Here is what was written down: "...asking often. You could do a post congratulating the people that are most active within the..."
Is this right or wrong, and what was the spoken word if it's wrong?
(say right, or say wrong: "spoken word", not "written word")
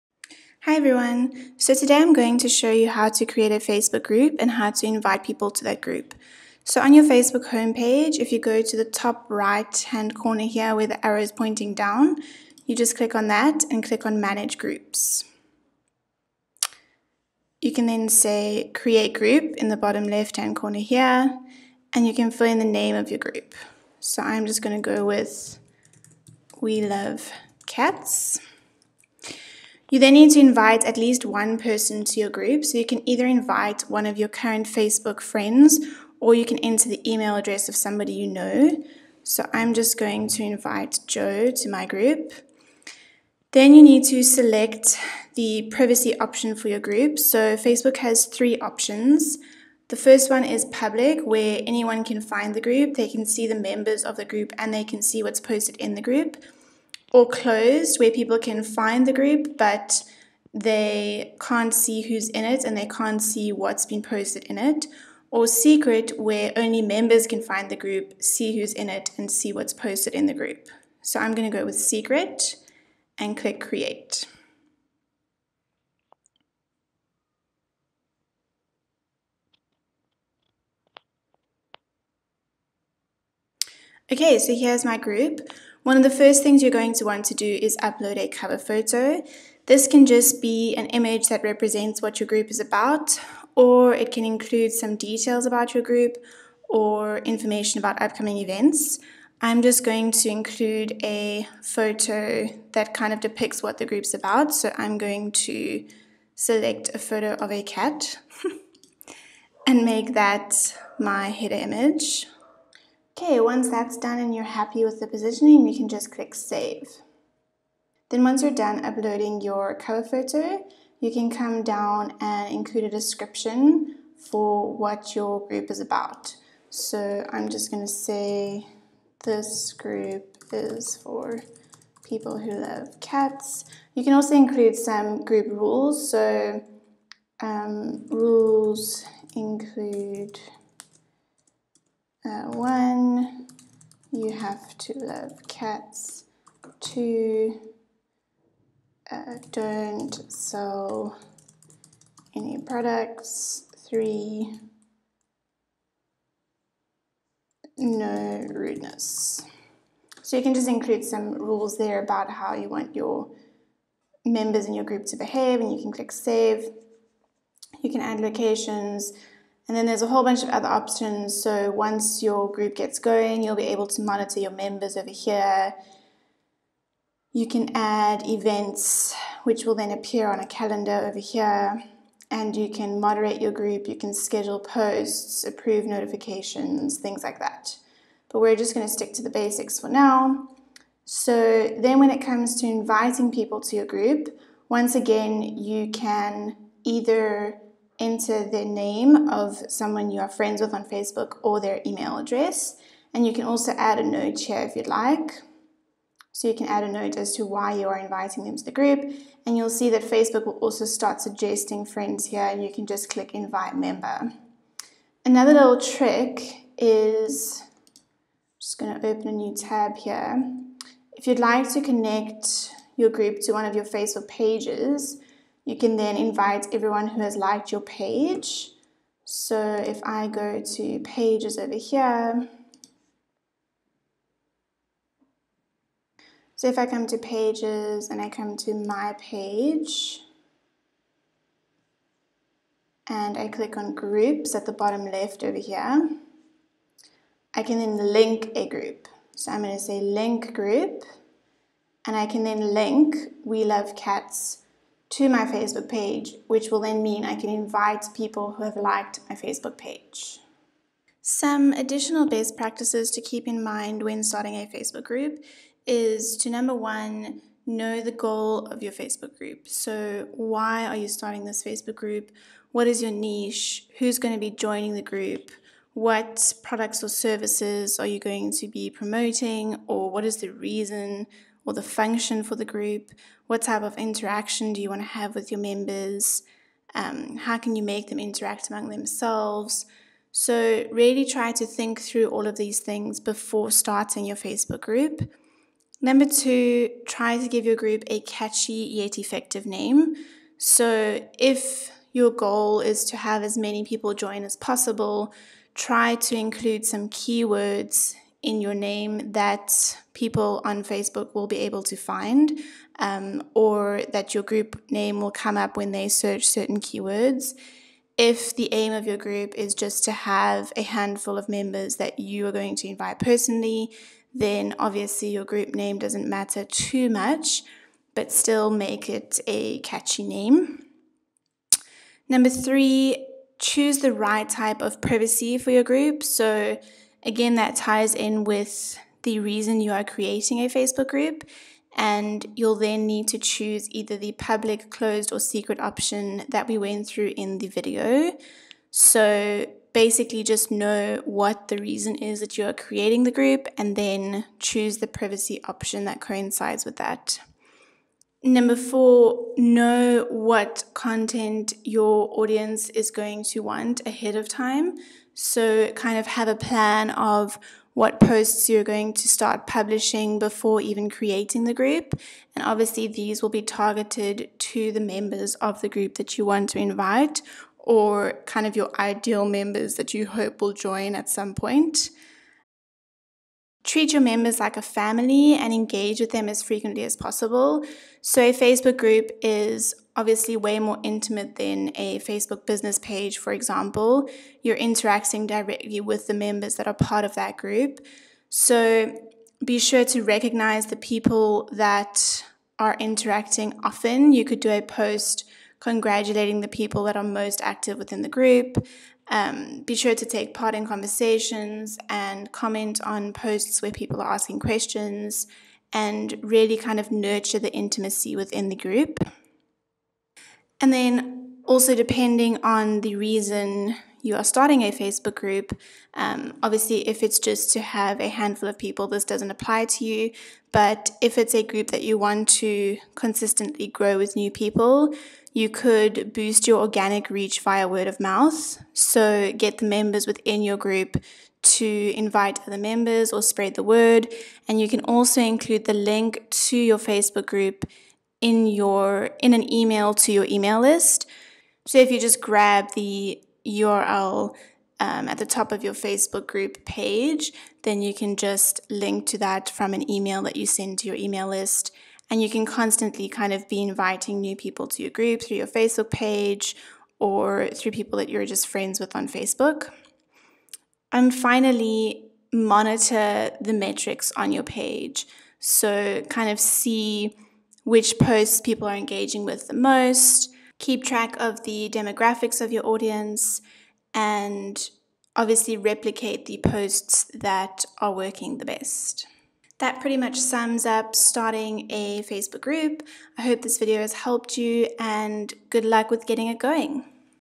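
wrong: "interacting", not "asking".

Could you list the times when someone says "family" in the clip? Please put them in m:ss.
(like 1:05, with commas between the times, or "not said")
6:24.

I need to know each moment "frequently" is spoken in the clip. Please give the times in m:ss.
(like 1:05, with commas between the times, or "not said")
6:26.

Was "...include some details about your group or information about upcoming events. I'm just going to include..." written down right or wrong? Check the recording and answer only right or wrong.
right.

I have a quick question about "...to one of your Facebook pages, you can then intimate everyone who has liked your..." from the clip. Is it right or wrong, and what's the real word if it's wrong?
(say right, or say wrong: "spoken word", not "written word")
wrong: "invite", not "intimate".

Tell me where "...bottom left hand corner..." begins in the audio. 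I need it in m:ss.
0:19.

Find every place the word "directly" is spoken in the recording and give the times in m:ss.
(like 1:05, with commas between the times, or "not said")
6:35.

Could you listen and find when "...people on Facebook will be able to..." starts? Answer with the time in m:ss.
5:10.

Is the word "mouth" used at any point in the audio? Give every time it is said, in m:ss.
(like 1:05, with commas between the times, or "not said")
7:18.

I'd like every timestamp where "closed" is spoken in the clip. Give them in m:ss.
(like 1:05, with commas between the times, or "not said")
0:57, 5:44.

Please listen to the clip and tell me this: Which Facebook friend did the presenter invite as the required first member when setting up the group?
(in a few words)
Joe.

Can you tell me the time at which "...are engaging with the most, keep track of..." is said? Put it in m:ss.
7:58.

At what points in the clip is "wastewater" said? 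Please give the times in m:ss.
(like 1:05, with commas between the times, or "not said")
not said.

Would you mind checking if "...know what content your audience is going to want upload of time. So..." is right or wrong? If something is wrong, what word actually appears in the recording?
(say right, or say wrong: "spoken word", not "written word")
wrong: "ahead", not "upload".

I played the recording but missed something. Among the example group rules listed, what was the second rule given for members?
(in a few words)
Don't sell any products.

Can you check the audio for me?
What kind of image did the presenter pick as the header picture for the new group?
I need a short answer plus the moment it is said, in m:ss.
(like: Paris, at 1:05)
A cat, at 1:47.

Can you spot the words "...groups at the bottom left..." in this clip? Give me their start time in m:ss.
4:03.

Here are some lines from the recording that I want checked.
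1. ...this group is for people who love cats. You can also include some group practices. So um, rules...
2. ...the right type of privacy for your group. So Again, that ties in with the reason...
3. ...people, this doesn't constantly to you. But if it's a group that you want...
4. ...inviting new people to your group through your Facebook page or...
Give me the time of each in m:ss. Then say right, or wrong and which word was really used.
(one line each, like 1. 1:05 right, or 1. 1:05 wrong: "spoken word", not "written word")
1. 2:09 wrong: "rules", not "practices"
2. 5:33 right
3. 7:08 wrong: "apply", not "constantly"
4. 7:43 right.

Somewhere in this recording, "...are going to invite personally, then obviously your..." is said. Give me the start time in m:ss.
5:22.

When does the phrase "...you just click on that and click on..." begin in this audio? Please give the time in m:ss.
0:12.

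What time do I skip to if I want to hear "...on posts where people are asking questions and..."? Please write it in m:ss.
6:53.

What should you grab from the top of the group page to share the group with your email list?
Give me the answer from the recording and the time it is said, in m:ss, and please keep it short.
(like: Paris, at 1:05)
The URL, at 7:33.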